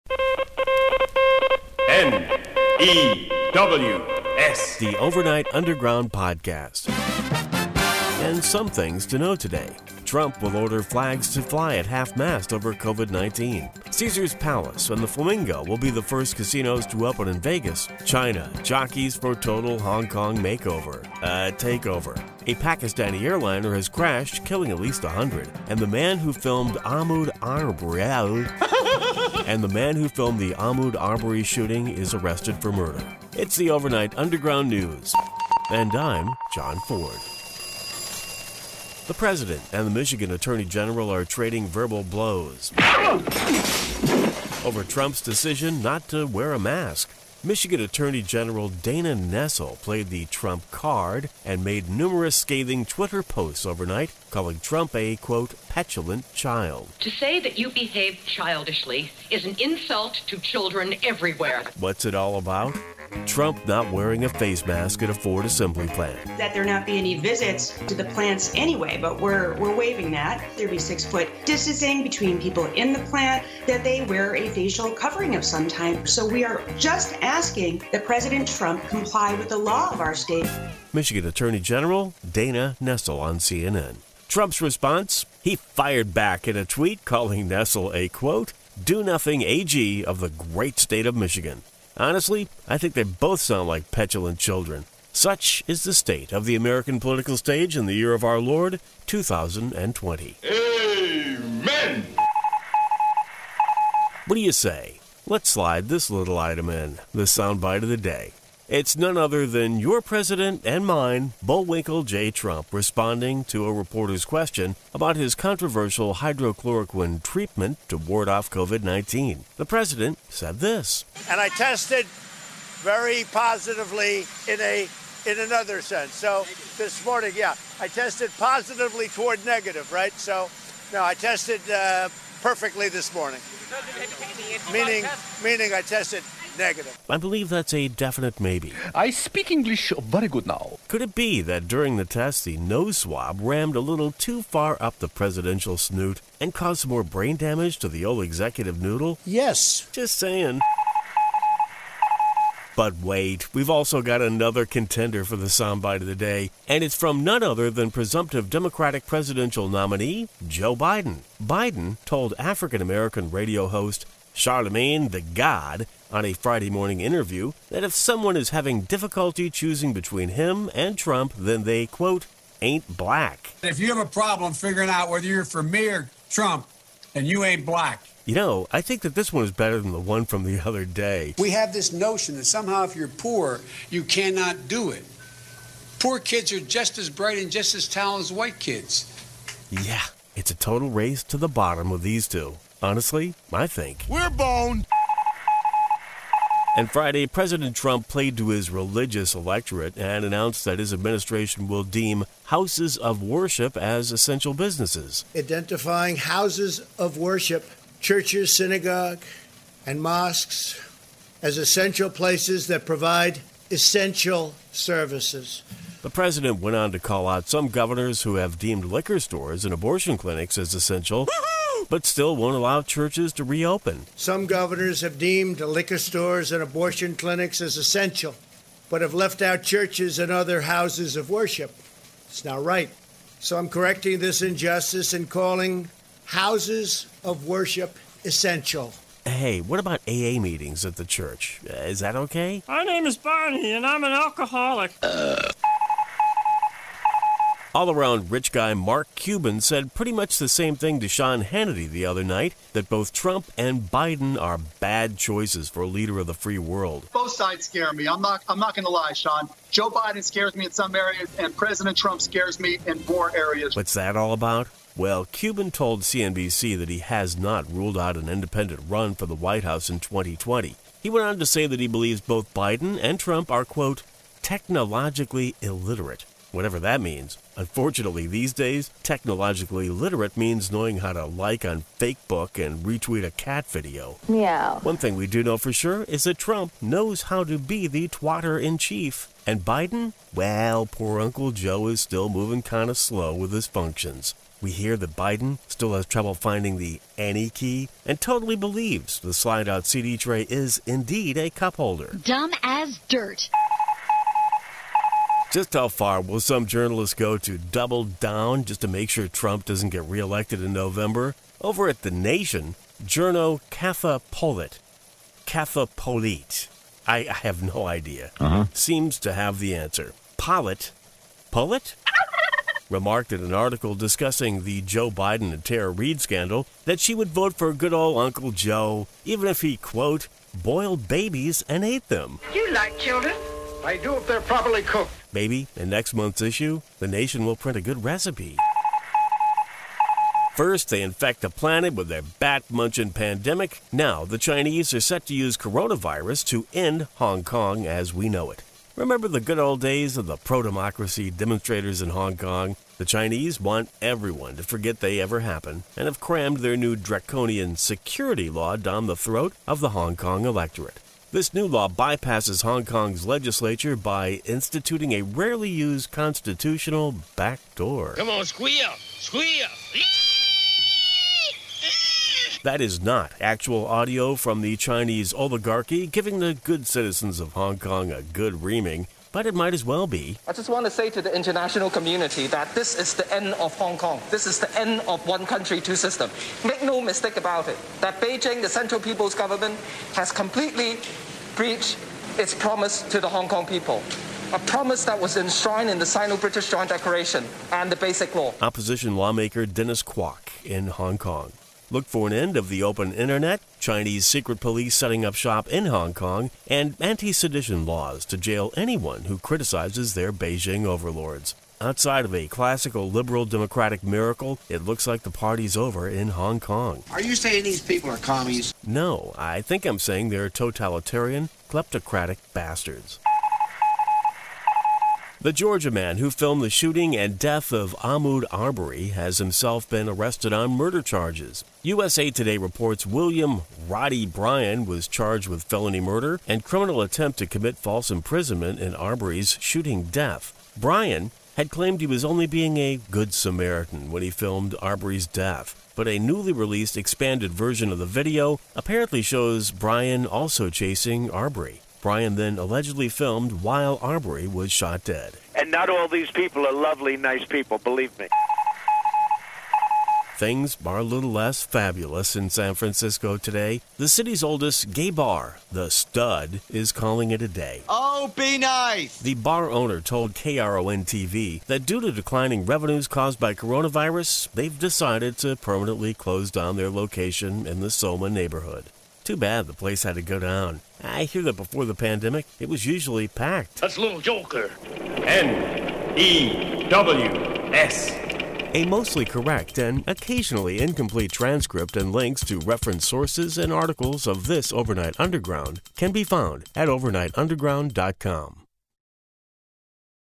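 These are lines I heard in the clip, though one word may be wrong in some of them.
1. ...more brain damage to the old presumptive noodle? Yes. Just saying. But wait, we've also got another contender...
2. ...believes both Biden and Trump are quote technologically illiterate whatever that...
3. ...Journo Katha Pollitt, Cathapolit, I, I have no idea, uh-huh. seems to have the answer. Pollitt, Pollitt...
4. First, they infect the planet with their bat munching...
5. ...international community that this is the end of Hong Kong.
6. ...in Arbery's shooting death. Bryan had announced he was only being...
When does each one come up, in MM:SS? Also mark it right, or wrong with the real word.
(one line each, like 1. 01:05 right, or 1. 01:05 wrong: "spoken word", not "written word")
1. 02:26 wrong: "executive", not "presumptive"
2. 04:31 right
3. 05:13 right
4. 05:40 right
5. 06:21 right
6. 07:18 wrong: "claimed", not "announced".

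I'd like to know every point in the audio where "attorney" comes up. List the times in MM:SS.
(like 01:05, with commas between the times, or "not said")
00:40, 00:47, 01:21.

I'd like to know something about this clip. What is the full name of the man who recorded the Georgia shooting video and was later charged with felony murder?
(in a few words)
William Roddy Bryan.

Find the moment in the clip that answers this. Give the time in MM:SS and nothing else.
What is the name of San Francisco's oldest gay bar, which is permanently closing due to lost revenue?
07:45.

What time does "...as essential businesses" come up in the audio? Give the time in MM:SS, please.
03:23.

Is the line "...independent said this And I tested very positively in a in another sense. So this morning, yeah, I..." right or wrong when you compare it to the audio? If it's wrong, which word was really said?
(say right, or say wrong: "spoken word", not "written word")
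wrong: "president", not "independent".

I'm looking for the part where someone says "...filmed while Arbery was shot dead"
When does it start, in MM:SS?
07:33.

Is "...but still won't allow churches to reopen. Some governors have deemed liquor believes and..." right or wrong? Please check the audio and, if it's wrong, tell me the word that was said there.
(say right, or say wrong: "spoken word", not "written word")
wrong: "stores", not "believes".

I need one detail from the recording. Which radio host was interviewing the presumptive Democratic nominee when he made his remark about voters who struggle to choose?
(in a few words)
Charlemagne the God.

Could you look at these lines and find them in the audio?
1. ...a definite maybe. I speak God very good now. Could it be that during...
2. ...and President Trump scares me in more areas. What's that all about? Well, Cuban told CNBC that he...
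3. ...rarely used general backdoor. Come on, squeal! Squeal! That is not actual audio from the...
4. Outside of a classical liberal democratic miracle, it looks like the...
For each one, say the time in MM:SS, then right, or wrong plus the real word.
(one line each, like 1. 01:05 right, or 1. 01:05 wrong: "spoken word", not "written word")
1. 02:17 wrong: "English", not "God"
2. 04:21 right
3. 06:05 wrong: "constitutional", not "general"
4. 06:51 right.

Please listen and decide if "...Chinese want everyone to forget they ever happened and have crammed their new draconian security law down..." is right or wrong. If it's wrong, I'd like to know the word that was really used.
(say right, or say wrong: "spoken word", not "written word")
right.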